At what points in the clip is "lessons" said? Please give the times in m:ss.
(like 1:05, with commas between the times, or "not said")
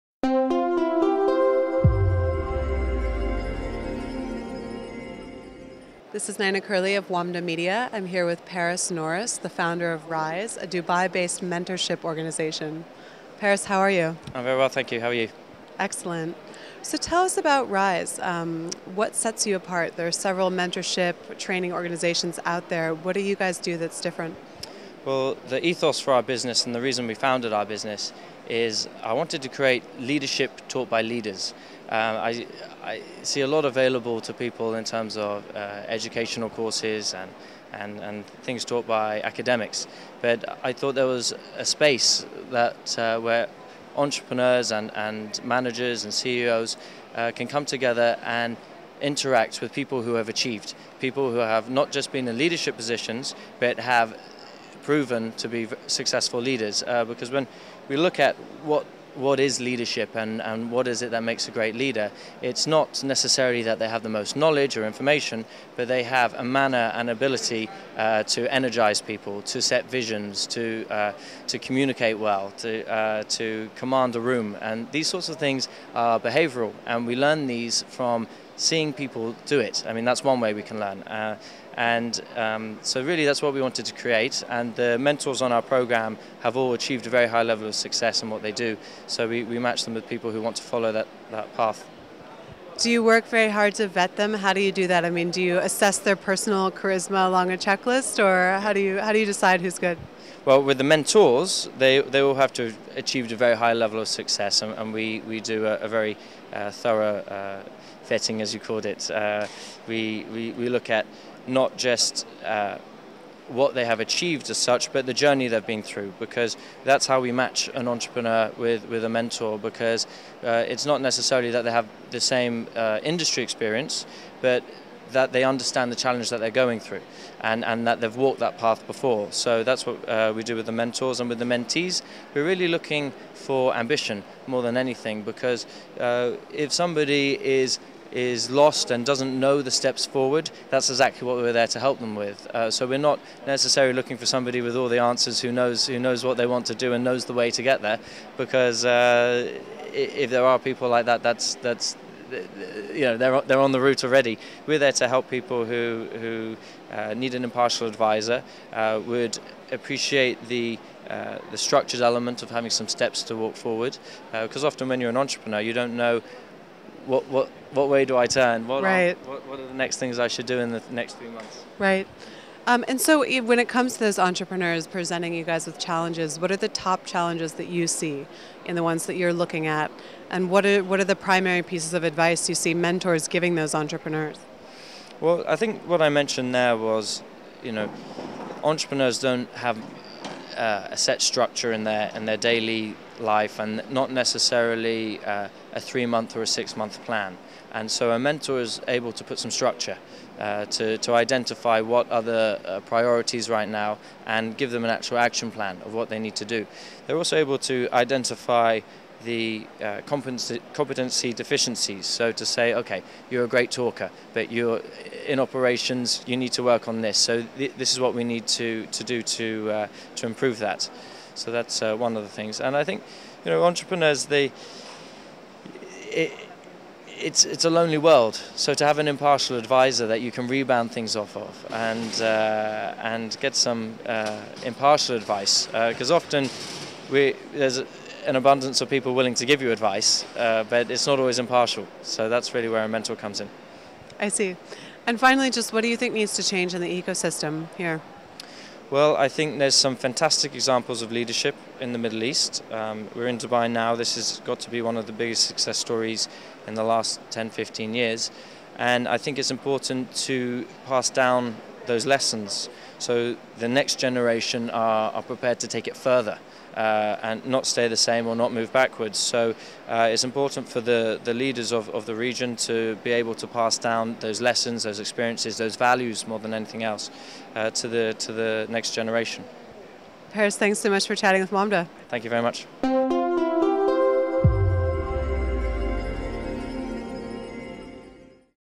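4:22, 4:34.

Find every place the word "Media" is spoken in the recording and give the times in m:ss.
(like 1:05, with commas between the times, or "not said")
0:07.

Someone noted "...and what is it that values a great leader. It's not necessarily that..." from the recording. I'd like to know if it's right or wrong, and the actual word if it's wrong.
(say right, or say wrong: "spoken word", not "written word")
wrong: "makes", not "values".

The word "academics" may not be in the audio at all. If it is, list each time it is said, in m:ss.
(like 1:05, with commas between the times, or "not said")
0:39.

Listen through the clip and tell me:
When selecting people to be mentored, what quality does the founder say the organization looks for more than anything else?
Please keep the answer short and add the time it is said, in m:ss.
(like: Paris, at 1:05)
Ambition, at 2:13.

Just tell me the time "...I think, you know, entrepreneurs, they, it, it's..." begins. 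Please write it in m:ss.
3:42.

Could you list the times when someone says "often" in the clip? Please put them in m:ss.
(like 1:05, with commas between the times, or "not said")
2:44, 3:56.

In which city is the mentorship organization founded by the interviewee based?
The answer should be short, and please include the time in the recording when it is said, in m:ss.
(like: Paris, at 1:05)
Dubai, at 0:10.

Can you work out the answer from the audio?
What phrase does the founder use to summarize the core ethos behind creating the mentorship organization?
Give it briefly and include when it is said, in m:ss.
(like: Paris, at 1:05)
Leadership taught by leaders, at 0:29.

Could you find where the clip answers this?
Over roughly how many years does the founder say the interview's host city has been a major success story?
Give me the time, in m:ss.
4:17.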